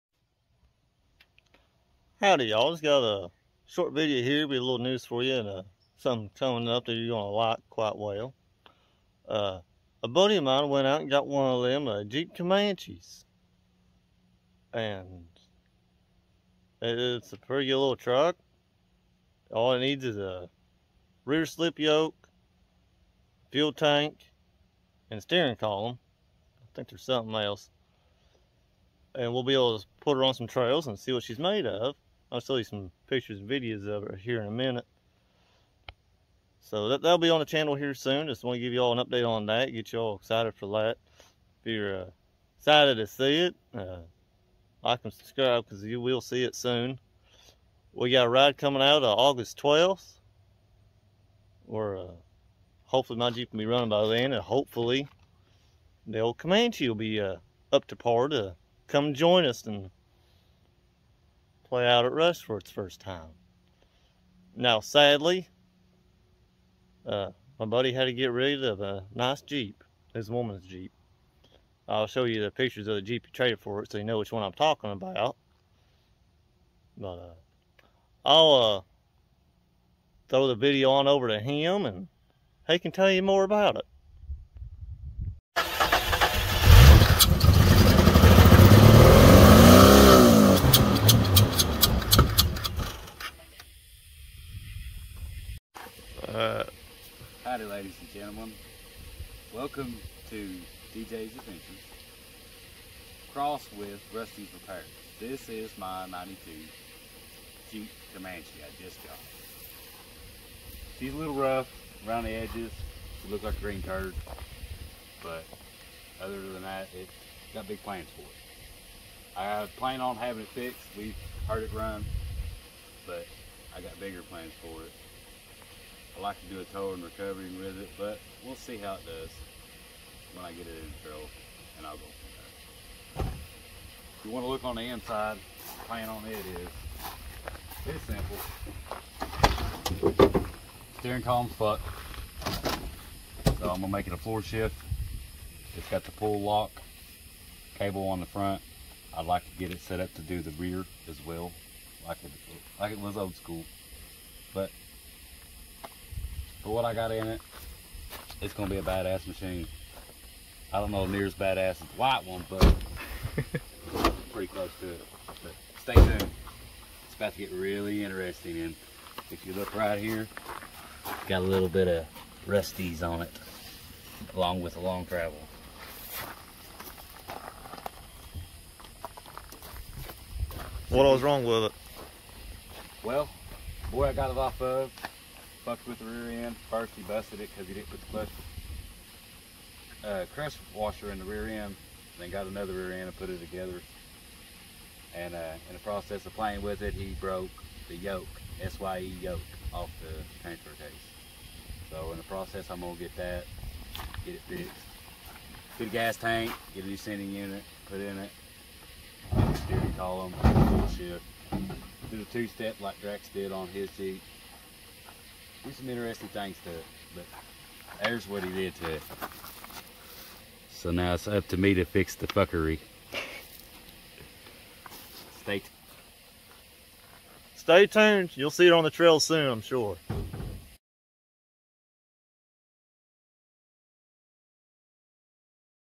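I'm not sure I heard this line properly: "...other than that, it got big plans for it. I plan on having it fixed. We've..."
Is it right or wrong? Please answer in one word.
right.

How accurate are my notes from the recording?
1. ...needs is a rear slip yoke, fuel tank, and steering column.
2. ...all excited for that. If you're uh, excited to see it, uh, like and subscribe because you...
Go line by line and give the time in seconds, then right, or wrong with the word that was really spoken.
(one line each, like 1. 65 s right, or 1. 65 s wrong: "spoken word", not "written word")
1. 19 s right
2. 39 s right.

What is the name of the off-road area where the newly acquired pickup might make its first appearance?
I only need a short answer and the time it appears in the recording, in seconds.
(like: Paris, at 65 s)
Rush, at 62 s.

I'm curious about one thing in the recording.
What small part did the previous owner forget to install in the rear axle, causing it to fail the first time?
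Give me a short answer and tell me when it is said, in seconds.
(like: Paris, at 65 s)
Crush washer, at 190 s.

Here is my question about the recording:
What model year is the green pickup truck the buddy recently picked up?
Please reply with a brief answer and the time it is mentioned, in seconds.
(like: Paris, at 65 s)
1992, at 106 s.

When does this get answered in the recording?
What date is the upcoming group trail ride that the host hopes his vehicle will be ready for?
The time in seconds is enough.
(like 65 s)
49 s.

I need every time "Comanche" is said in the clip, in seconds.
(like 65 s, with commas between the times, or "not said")
12 s, 56 s, 108 s.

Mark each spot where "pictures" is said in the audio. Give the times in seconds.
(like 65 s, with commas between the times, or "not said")
33 s, 72 s.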